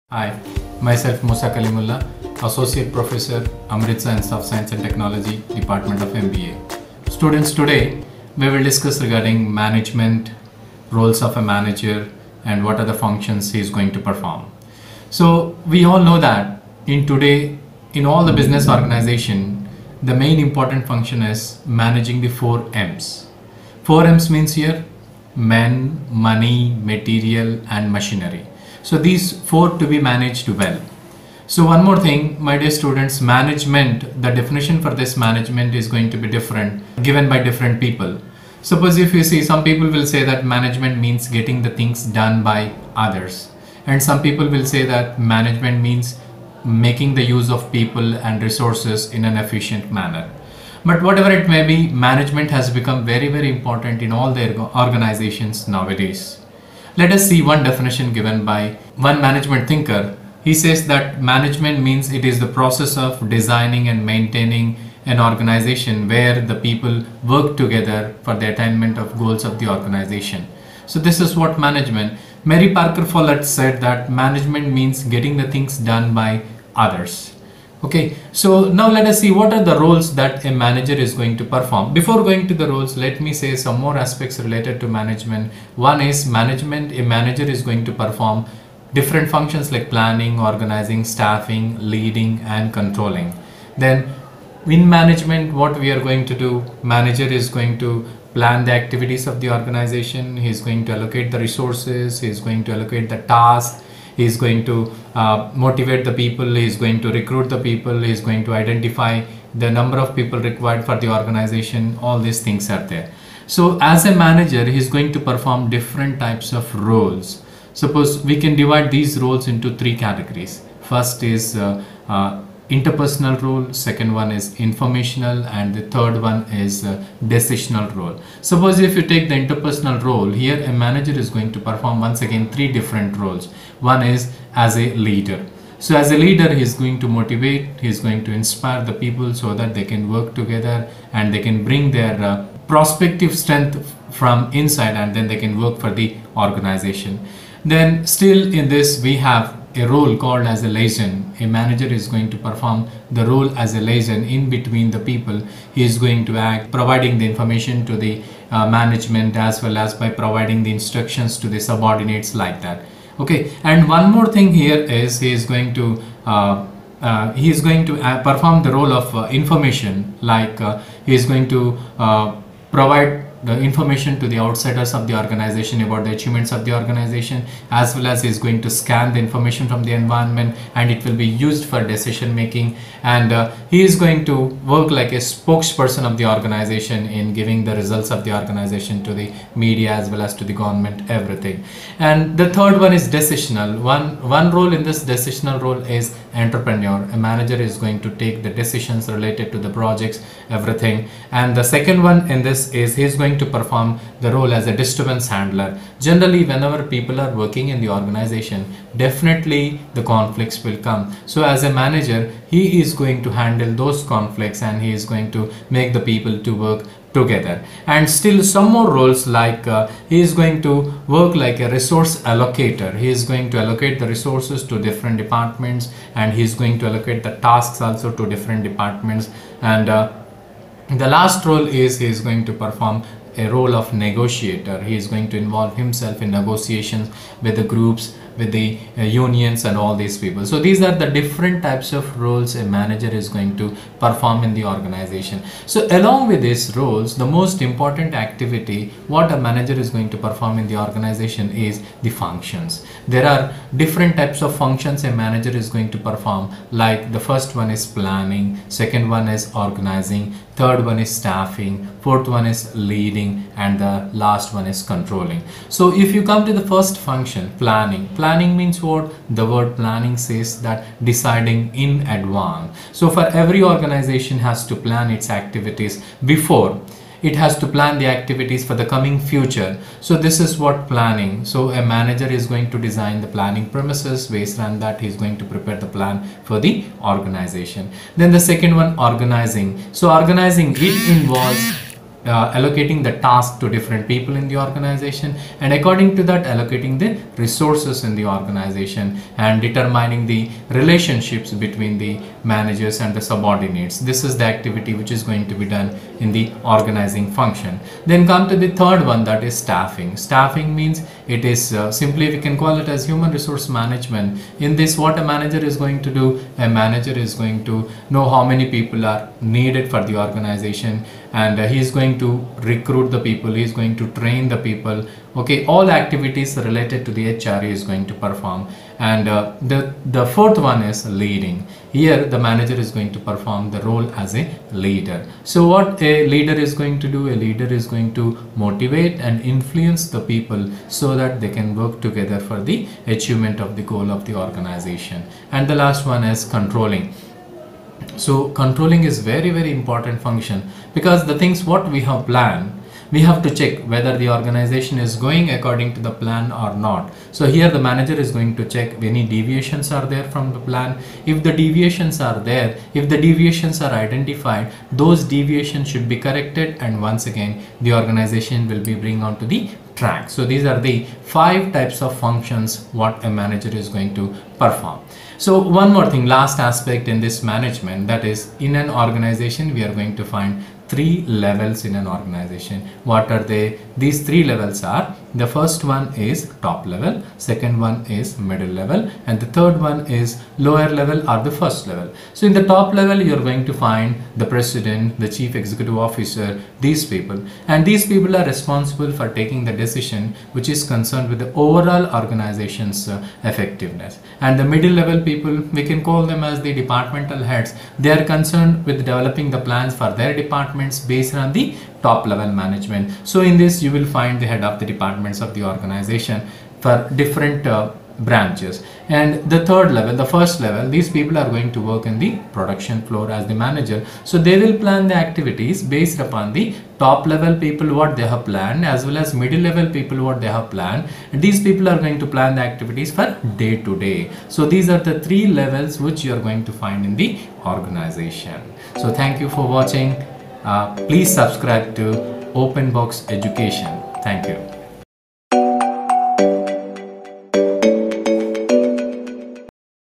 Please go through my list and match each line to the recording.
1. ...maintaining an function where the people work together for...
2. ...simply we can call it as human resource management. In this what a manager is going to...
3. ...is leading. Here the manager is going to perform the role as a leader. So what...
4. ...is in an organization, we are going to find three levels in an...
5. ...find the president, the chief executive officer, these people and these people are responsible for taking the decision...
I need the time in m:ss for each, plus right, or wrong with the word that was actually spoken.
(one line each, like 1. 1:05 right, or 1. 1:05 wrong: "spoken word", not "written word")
1. 1:04 wrong: "organization", not "function"
2. 5:11 right
3. 5:30 right
4. 6:18 right
5. 6:33 right.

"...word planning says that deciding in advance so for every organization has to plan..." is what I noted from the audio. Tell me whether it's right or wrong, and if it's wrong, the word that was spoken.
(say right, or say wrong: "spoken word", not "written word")
right.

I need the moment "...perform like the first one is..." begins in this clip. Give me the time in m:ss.
4:15.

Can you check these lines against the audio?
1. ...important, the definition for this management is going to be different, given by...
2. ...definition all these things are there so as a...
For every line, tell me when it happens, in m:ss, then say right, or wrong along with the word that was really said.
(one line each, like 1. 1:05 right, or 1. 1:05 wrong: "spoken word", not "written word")
1. 0:33 wrong: "management", not "important"
2. 1:51 wrong: "organization", not "definition".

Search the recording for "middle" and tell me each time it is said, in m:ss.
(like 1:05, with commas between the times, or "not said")
6:28, 6:44, 7:09.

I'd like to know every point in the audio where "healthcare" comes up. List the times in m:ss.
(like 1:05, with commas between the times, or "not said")
not said.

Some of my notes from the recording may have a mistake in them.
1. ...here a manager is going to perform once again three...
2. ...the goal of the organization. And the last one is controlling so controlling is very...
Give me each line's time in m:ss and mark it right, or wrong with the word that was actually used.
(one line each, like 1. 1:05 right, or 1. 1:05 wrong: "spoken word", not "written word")
1. 2:10 right
2. 5:43 right.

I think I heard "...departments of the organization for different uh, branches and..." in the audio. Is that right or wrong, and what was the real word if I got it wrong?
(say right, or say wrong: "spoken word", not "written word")
right.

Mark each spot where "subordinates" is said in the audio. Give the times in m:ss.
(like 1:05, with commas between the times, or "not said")
2:41, 5:03.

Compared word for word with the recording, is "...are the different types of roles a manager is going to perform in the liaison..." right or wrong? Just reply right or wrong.
wrong.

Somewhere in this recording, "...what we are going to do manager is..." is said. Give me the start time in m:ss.
1:35.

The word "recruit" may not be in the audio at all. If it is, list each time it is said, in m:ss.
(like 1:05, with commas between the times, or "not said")
1:47, 5:22.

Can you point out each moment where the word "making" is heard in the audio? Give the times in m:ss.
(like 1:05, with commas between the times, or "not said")
0:46, 3:02.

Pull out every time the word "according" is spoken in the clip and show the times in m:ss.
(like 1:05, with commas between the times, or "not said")
4:55, 5:55.